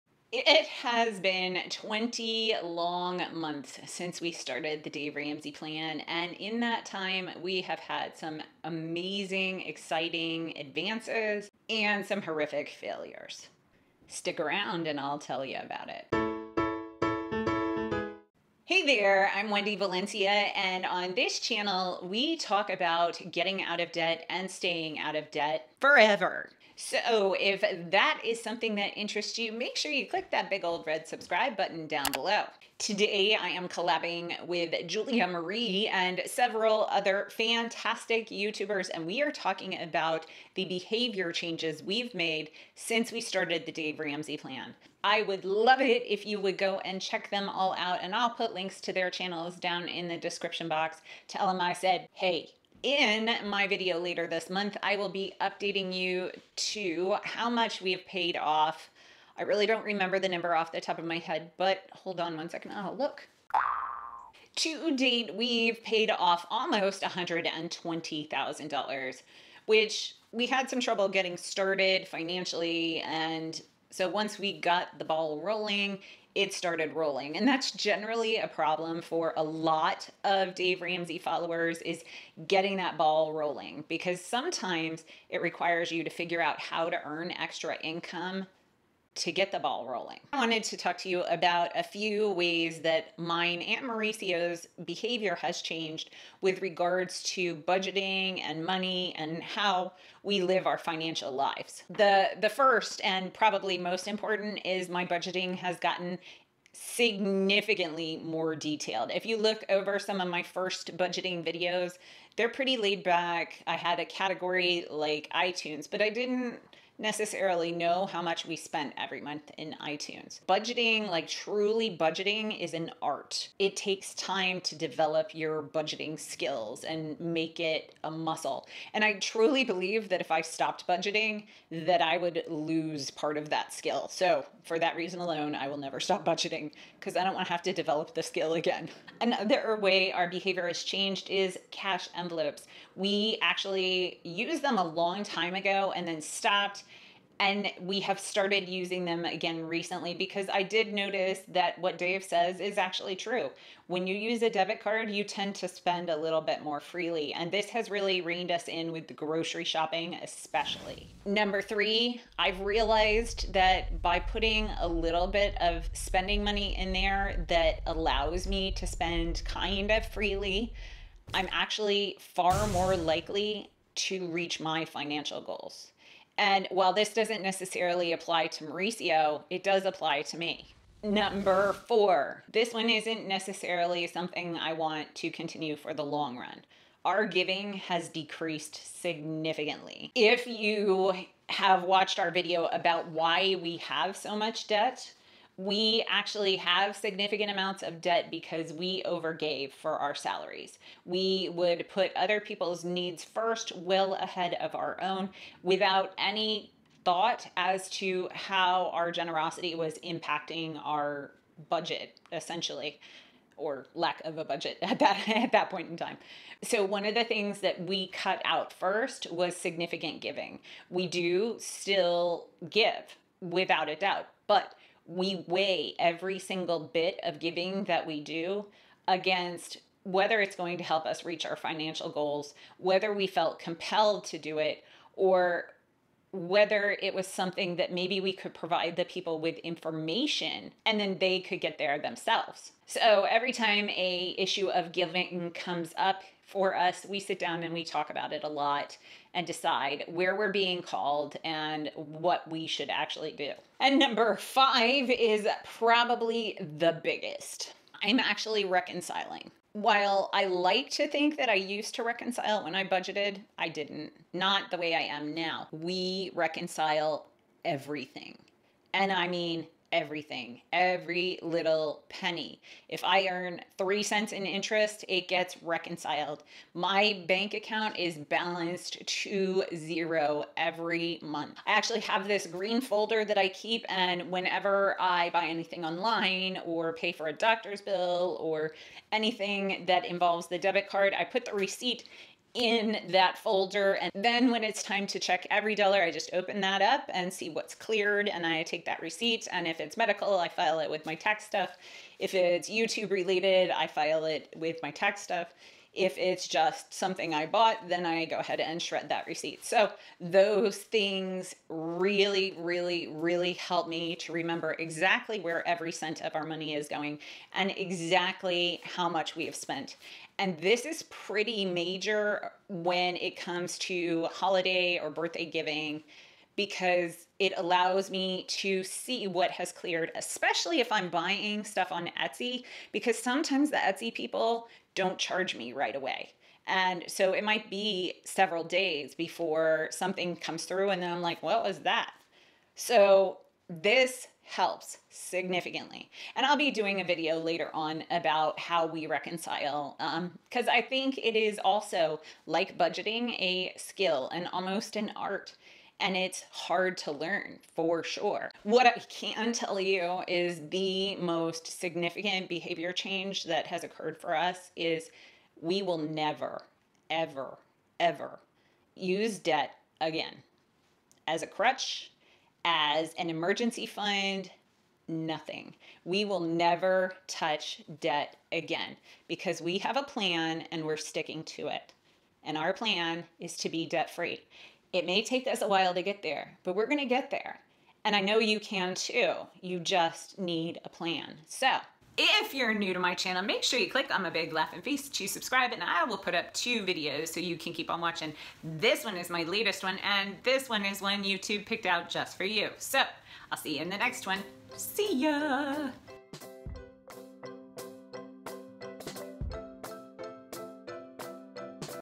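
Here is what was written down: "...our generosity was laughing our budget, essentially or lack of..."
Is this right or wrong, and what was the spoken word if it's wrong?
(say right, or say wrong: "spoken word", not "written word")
wrong: "impacting", not "laughing".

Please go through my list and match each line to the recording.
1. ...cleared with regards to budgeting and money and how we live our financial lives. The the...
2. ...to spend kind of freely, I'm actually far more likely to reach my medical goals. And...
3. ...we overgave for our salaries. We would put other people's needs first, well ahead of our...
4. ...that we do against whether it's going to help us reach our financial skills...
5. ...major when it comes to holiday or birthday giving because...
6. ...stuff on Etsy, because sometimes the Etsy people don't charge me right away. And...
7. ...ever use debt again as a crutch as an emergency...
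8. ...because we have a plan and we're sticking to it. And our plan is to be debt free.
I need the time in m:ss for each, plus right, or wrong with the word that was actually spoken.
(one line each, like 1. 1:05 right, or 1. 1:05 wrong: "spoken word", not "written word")
1. 1:35 wrong: "changed", not "cleared"
2. 2:48 wrong: "financial", not "medical"
3. 3:18 right
4. 3:47 wrong: "goals", not "skills"
5. 5:21 right
6. 5:31 right
7. 6:07 right
8. 6:19 right.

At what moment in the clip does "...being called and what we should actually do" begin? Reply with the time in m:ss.
4:10.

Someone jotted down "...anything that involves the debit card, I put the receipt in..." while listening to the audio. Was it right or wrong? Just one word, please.
right.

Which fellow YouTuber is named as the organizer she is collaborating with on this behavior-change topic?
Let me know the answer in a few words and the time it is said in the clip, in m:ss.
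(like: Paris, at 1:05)
Julia Marie, at 0:34.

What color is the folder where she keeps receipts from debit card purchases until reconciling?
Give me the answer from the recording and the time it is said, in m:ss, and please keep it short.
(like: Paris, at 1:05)
green, at 4:42.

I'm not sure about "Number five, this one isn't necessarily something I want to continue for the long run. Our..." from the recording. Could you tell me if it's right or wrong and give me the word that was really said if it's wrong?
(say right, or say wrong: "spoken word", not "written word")
wrong: "four", not "five".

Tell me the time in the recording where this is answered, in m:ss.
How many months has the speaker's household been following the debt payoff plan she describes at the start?
0:01.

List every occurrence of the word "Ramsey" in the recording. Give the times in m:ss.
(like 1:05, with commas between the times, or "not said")
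0:05, 0:43, 1:20.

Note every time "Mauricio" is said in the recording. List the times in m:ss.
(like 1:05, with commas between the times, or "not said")
1:33, 2:58.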